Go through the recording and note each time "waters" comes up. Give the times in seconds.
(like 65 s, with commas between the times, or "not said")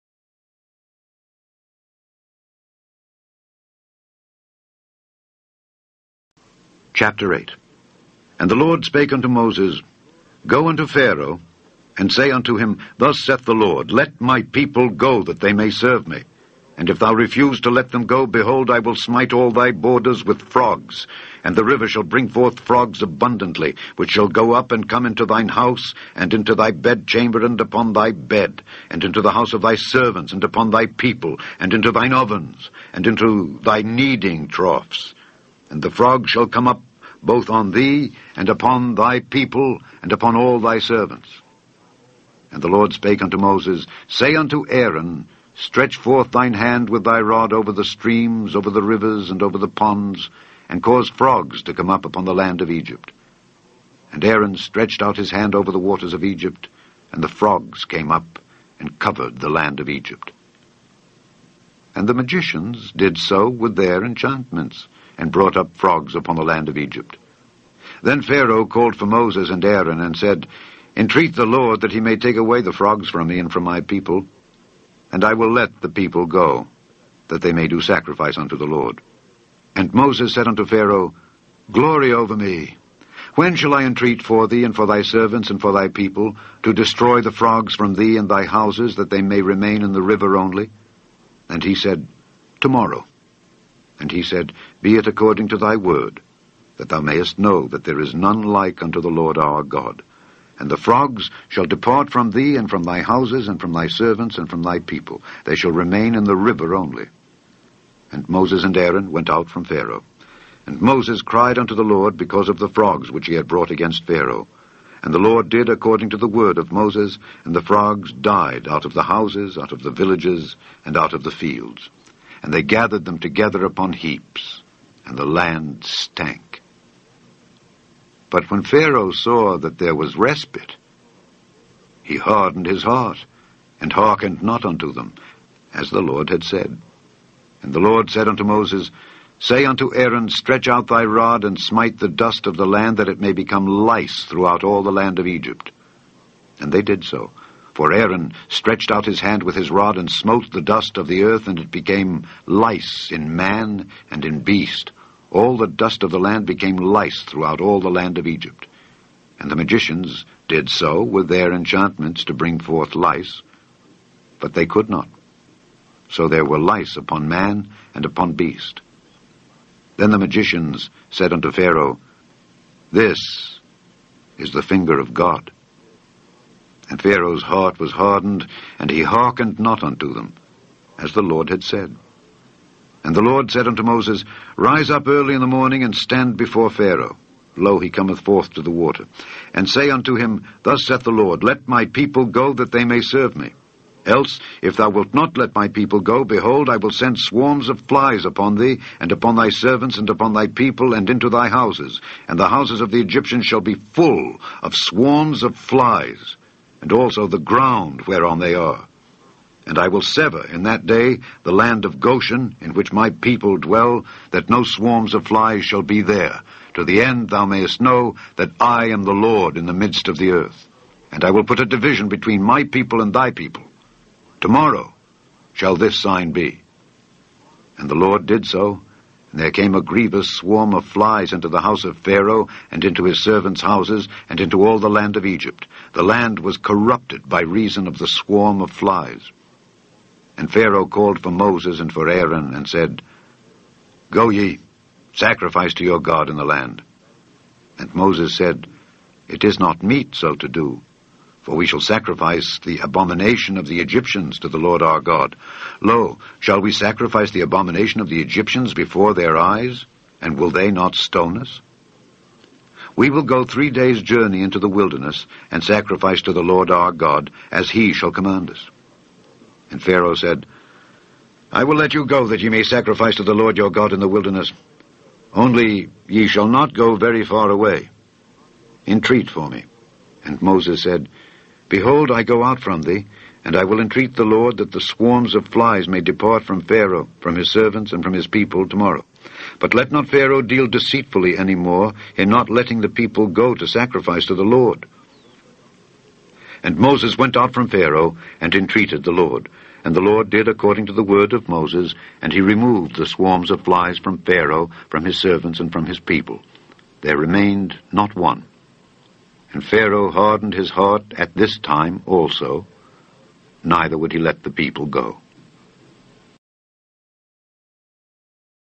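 55 s, 188 s.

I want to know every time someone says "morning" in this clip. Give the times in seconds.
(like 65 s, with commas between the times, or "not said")
185 s.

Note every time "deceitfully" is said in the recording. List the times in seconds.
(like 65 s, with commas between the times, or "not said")
290 s.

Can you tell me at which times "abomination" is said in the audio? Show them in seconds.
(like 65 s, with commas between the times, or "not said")
252 s, 257 s.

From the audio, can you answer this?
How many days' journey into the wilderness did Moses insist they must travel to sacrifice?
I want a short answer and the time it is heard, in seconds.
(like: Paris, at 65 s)
3, at 263 s.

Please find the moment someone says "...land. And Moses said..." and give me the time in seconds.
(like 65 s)
246 s.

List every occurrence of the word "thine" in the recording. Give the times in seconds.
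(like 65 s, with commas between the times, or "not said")
25 s, 31 s, 46 s.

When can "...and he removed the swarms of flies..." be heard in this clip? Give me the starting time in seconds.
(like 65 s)
302 s.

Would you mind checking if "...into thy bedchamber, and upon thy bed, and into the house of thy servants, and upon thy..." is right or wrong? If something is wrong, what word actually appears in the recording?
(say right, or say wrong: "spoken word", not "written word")
right.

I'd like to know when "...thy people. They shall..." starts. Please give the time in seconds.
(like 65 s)
104 s.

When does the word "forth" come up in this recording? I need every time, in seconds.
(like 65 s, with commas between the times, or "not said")
22 s, 45 s, 162 s, 188 s.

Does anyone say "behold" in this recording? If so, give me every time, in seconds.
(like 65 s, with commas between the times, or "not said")
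18 s, 196 s, 281 s.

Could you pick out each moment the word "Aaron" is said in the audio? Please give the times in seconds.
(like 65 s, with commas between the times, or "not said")
44 s, 54 s, 69 s, 108 s, 139 s, 147 s, 242 s.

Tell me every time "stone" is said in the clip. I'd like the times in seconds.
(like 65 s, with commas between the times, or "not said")
260 s.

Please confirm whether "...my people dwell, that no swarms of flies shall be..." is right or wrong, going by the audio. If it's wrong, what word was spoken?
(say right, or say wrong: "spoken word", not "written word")
right.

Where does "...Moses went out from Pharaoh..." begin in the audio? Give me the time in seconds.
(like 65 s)
296 s.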